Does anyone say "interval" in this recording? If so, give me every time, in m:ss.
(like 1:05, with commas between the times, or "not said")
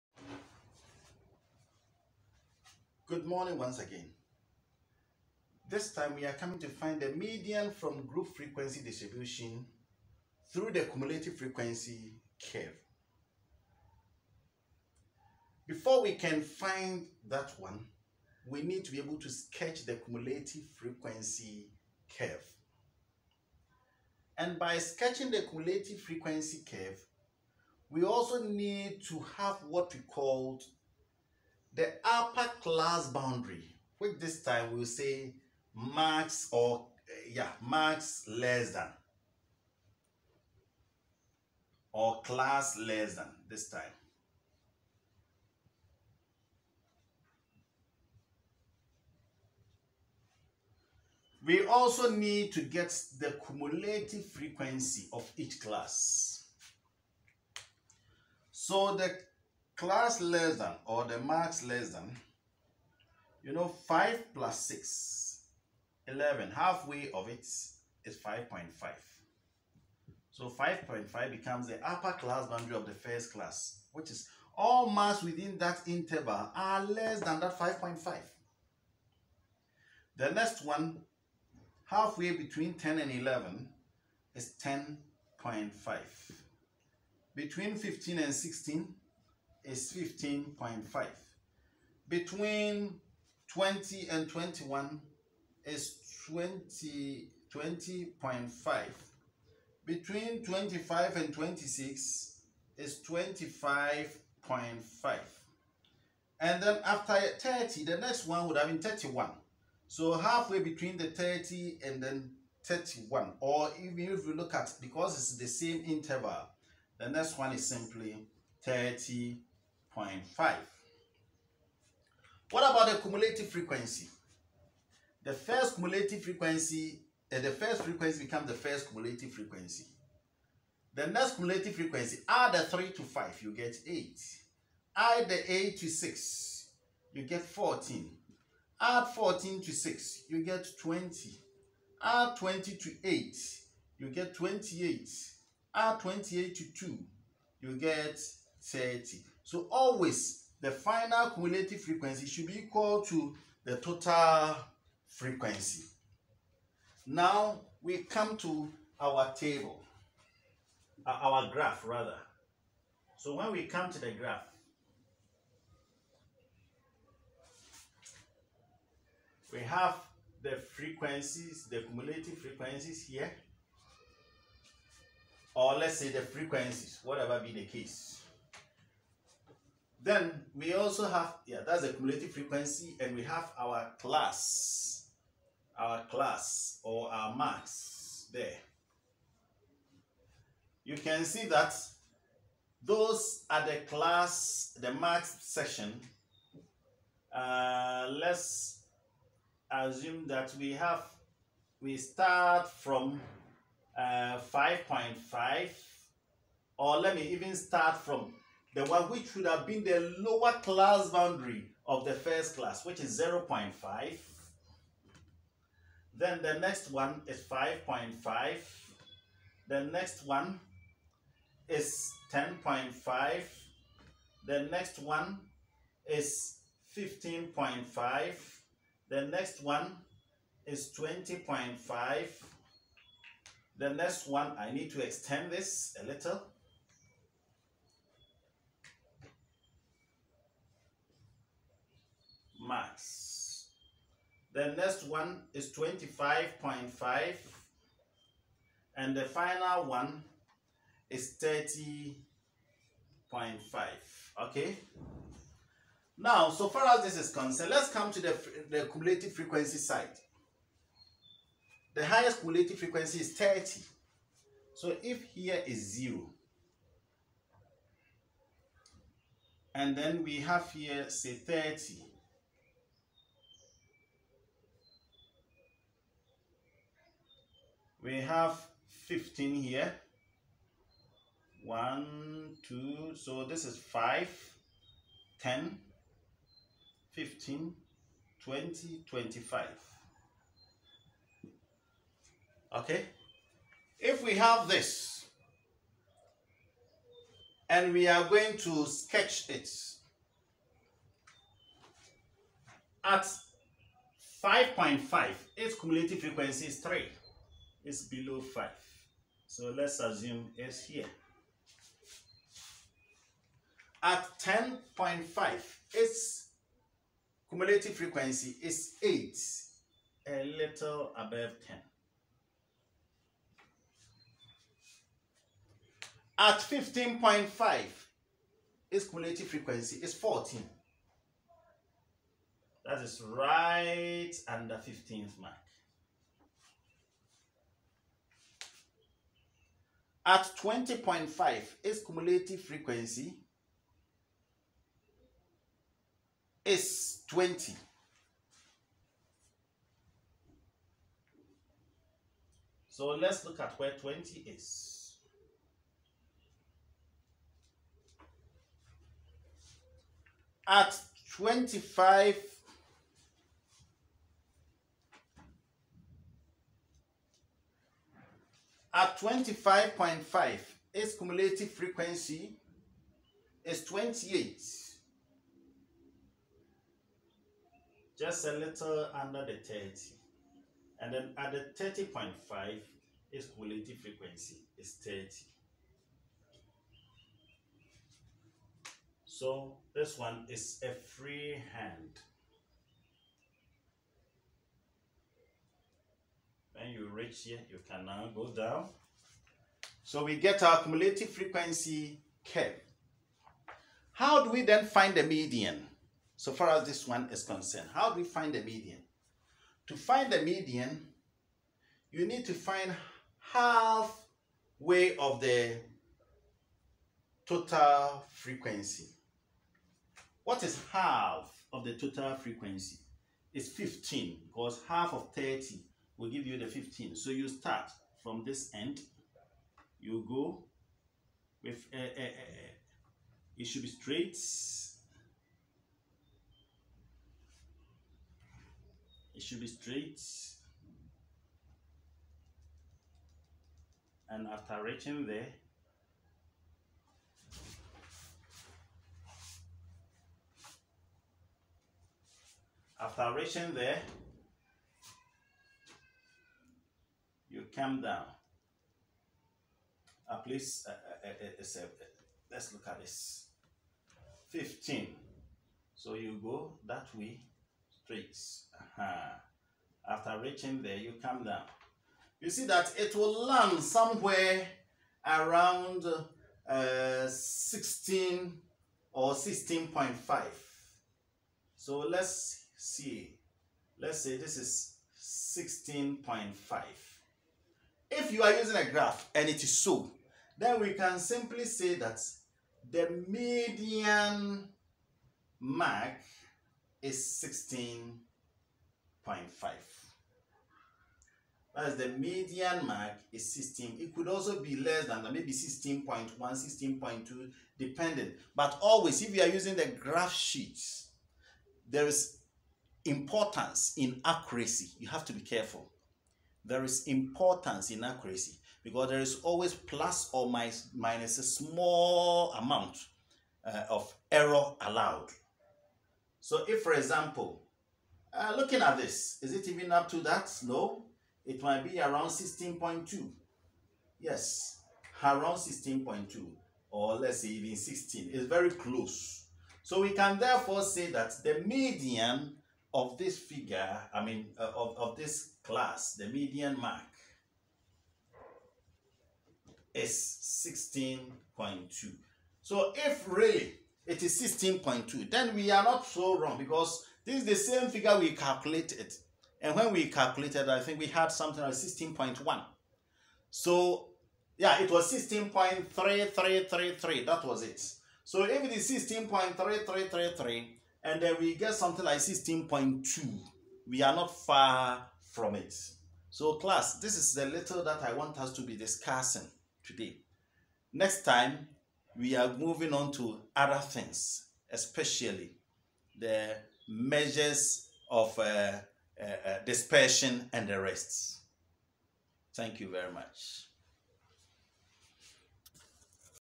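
1:15, 1:55.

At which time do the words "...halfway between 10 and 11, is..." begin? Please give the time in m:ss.
1:21.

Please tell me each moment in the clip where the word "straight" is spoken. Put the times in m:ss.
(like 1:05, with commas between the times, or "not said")
7:13, 7:19, 7:48.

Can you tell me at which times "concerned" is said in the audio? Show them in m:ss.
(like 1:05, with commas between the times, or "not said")
4:17, 6:47.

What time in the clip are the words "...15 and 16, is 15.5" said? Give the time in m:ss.
1:27.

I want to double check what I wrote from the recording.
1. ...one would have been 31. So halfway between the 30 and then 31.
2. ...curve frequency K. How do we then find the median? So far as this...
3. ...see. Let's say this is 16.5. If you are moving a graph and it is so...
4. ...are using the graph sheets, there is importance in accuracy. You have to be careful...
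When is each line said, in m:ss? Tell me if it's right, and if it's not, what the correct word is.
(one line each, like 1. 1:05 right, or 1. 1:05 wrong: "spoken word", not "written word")
1. 1:48 right
2. 6:40 wrong: "cumulative", not "curve"
3. 8:02 wrong: "using", not "moving"
4. 8:29 right.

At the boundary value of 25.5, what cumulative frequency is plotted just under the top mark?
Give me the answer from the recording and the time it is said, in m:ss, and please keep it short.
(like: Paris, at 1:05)
28, at 6:10.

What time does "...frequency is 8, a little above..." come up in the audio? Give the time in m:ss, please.
5:17.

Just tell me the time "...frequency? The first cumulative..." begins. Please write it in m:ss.
2:03.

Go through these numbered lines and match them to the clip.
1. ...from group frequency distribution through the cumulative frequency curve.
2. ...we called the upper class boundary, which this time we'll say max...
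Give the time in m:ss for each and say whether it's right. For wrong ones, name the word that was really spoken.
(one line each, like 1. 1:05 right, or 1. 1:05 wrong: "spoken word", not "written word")
1. 0:07 right
2. 0:29 right.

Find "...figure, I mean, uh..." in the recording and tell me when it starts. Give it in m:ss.
9:03.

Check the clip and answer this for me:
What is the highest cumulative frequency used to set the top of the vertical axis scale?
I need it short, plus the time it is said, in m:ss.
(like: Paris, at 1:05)
30, at 4:21.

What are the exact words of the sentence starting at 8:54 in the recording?
Yes, around 16.2 or let's say even 16.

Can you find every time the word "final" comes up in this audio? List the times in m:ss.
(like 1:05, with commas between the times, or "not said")
2:30, 4:09.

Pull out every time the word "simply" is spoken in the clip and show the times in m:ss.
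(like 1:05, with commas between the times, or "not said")
1:57, 8:11.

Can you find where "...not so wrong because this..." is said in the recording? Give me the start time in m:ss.
9:15.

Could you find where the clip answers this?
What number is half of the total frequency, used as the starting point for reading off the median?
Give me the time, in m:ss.
7:03.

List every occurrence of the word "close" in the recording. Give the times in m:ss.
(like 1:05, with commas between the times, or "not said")
8:58.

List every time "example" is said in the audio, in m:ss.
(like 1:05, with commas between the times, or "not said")
8:46.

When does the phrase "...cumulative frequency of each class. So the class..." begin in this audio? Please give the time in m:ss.
0:53.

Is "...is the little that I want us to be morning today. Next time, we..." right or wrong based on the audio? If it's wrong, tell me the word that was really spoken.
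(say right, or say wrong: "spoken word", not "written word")
wrong: "discussing", not "morning".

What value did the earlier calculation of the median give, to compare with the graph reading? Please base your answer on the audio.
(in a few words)
16.3333.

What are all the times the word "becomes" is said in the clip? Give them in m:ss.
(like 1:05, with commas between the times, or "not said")
1:11, 2:08.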